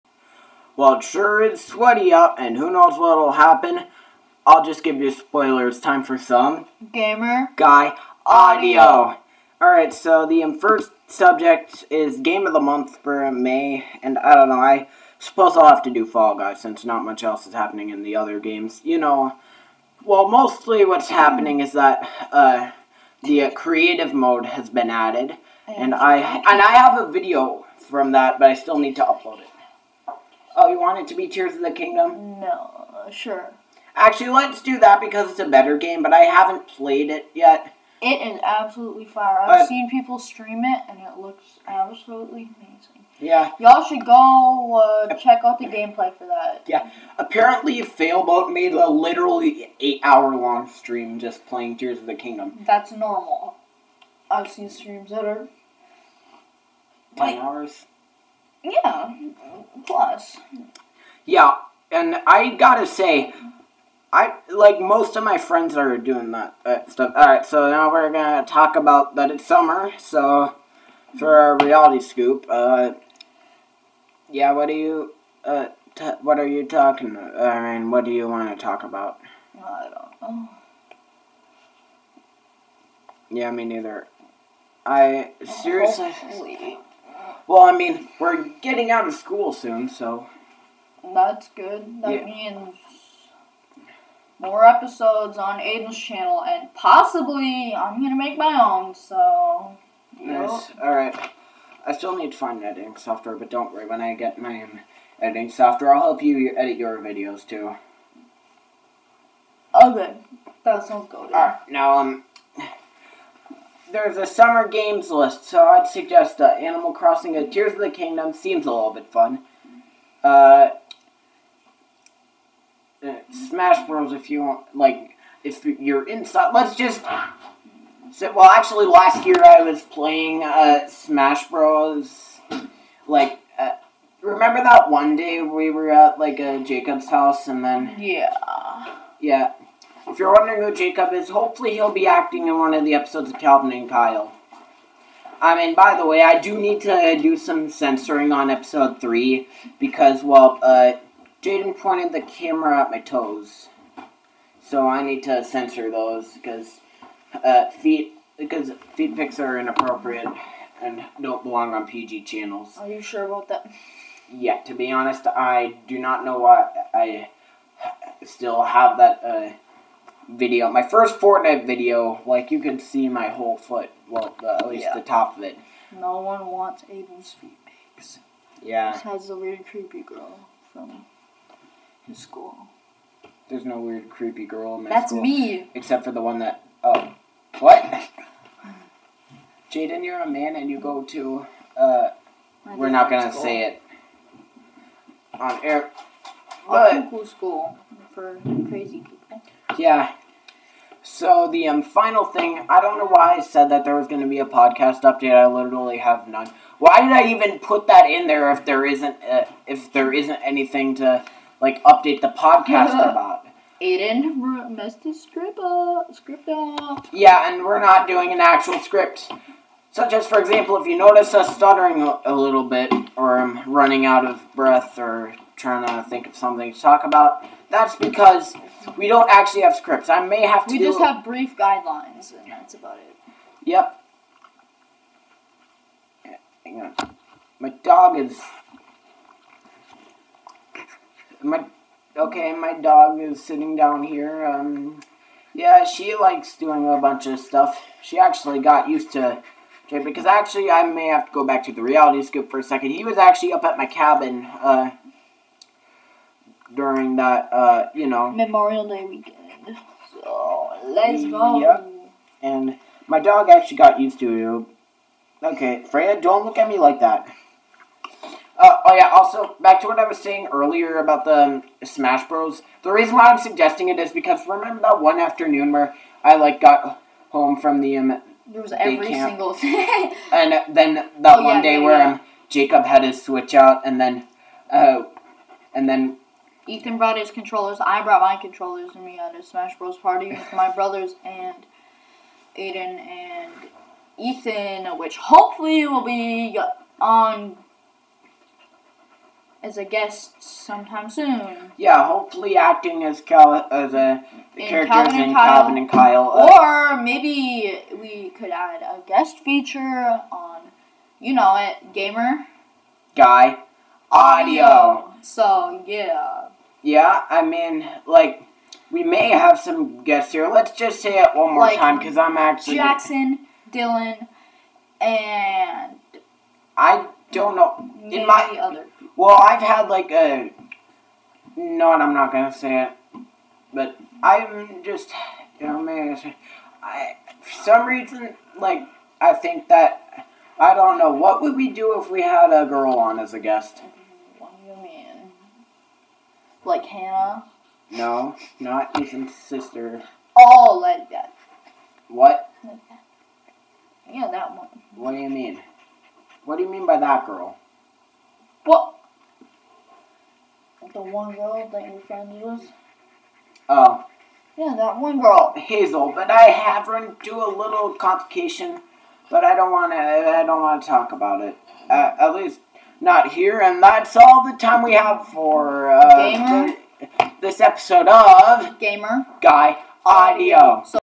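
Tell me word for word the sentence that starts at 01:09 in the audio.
So for our reality scoop, uh, yeah, what do you, uh, what are you talking?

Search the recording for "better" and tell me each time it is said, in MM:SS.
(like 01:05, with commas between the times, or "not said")
00:35.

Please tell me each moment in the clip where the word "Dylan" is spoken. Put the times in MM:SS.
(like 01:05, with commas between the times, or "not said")
05:23.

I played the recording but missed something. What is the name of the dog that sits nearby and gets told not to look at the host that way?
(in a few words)
Freya.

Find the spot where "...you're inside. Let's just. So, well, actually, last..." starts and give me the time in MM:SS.
02:05.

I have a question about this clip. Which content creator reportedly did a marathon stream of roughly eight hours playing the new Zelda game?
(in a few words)
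Failboat.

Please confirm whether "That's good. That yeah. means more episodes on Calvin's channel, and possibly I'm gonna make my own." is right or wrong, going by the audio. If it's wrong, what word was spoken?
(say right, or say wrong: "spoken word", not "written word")
wrong: "Aiden", not "Calvin".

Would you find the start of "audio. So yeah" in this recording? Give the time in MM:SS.
05:14.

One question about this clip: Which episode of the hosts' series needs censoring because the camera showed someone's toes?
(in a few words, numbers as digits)
3.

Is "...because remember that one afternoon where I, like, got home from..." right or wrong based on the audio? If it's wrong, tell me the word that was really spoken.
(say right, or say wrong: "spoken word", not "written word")
right.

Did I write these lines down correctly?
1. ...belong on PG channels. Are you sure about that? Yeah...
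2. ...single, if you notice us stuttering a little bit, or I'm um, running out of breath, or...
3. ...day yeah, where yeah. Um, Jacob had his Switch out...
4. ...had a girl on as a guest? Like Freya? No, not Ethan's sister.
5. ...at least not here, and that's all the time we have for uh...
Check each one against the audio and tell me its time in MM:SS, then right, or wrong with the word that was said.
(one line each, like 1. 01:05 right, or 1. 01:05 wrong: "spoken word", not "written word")
1. 02:41 right
2. 03:40 wrong: "example", not "single"
3. 04:41 right
4. 05:42 wrong: "Hannah", not "Freya"
5. 06:12 right.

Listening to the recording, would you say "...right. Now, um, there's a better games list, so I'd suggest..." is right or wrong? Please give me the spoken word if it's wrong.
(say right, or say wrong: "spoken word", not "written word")
wrong: "summer", not "better".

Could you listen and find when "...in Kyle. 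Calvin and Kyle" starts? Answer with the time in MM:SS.
05:05.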